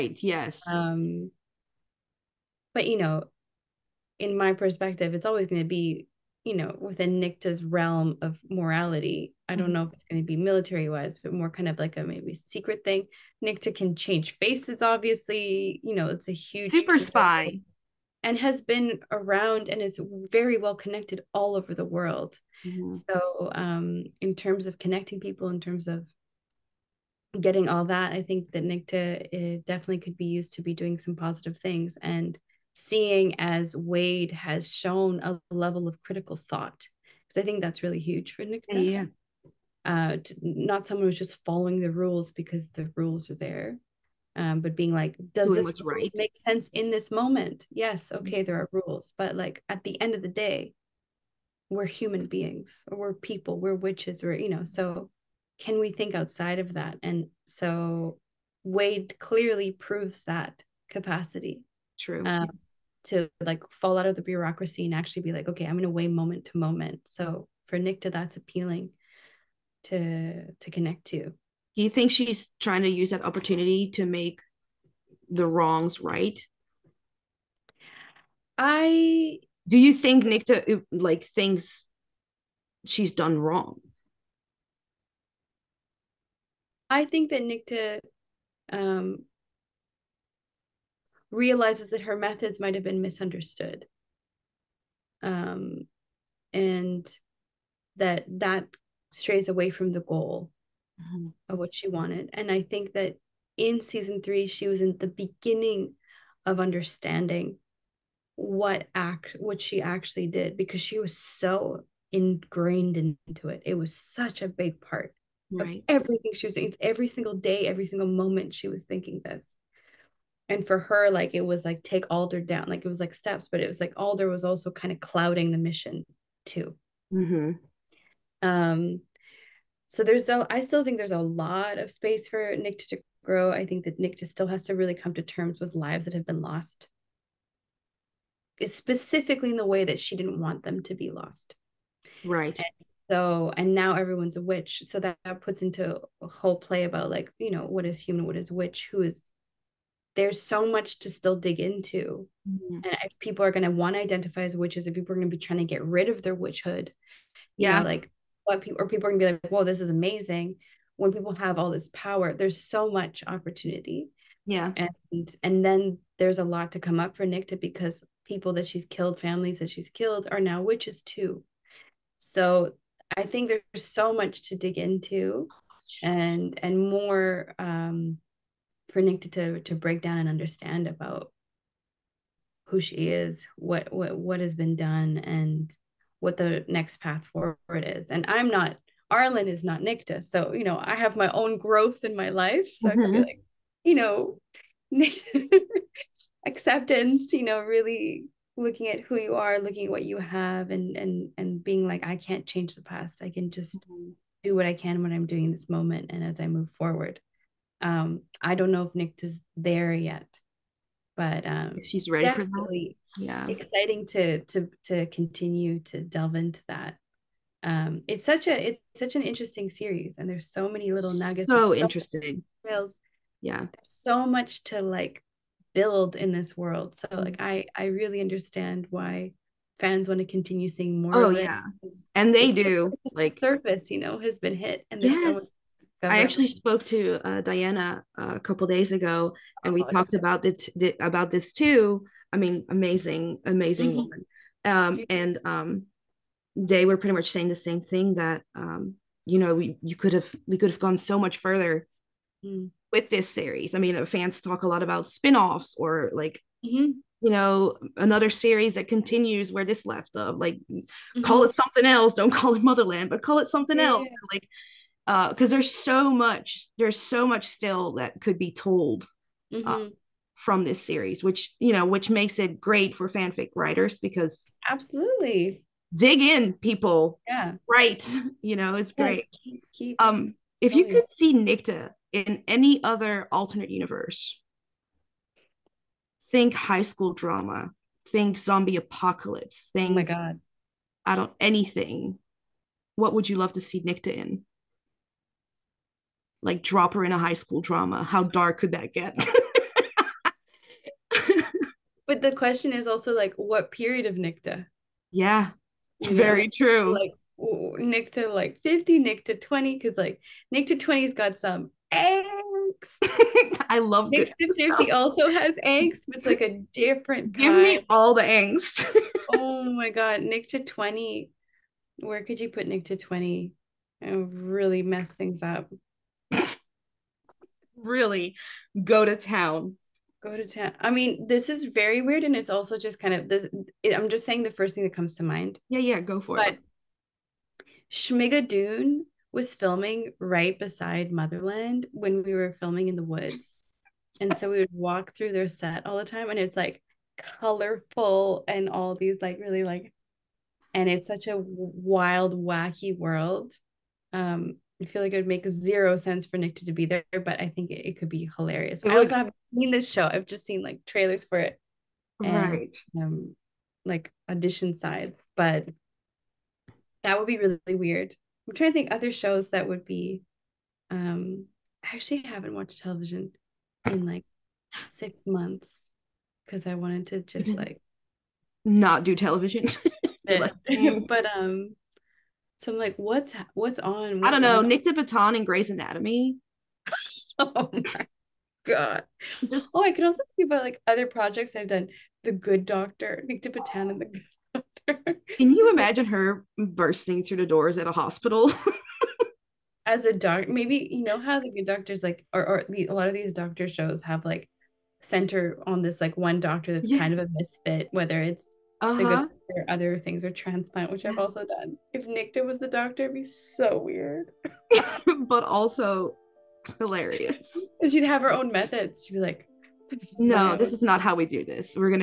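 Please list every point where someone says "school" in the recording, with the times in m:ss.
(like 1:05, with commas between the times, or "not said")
4:46, 4:57.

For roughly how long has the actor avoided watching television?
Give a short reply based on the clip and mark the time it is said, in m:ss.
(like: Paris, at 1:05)
6 months, at 6:14.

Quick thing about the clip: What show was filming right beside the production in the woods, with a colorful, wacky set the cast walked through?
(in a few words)
Schmigadoon.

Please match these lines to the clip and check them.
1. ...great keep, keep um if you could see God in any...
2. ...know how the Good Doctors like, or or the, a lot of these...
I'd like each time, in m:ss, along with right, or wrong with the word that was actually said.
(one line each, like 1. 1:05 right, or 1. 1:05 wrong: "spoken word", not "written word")
1. 4:39 wrong: "Nicte", not "God"
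2. 6:41 right.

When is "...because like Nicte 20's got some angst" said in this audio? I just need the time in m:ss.
5:09.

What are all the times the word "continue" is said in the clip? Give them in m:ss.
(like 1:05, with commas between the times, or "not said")
3:35, 3:50, 4:18.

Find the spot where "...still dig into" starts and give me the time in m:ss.
2:31.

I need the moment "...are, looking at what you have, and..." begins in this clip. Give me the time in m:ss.
3:19.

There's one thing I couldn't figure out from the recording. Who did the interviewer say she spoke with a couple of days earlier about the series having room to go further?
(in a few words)
Diana.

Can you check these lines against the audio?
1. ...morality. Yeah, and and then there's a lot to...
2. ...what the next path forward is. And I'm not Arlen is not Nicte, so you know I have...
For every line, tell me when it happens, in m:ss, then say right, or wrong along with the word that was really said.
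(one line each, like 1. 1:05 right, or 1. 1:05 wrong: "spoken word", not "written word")
1. 2:43 wrong: "opportunity", not "morality"
2. 3:06 right.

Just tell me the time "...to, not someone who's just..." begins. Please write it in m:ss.
0:40.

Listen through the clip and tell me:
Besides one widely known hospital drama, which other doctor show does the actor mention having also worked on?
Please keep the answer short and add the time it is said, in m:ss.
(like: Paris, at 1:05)
Transplant, at 6:50.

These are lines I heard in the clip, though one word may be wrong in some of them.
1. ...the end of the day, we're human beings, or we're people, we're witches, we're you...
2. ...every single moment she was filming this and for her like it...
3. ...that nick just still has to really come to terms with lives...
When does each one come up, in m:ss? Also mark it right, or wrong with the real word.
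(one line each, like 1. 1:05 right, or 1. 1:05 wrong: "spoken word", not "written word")
1. 0:49 right
2. 1:57 wrong: "thinking", not "filming"
3. 2:13 right.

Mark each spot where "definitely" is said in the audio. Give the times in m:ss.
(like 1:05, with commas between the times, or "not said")
0:29.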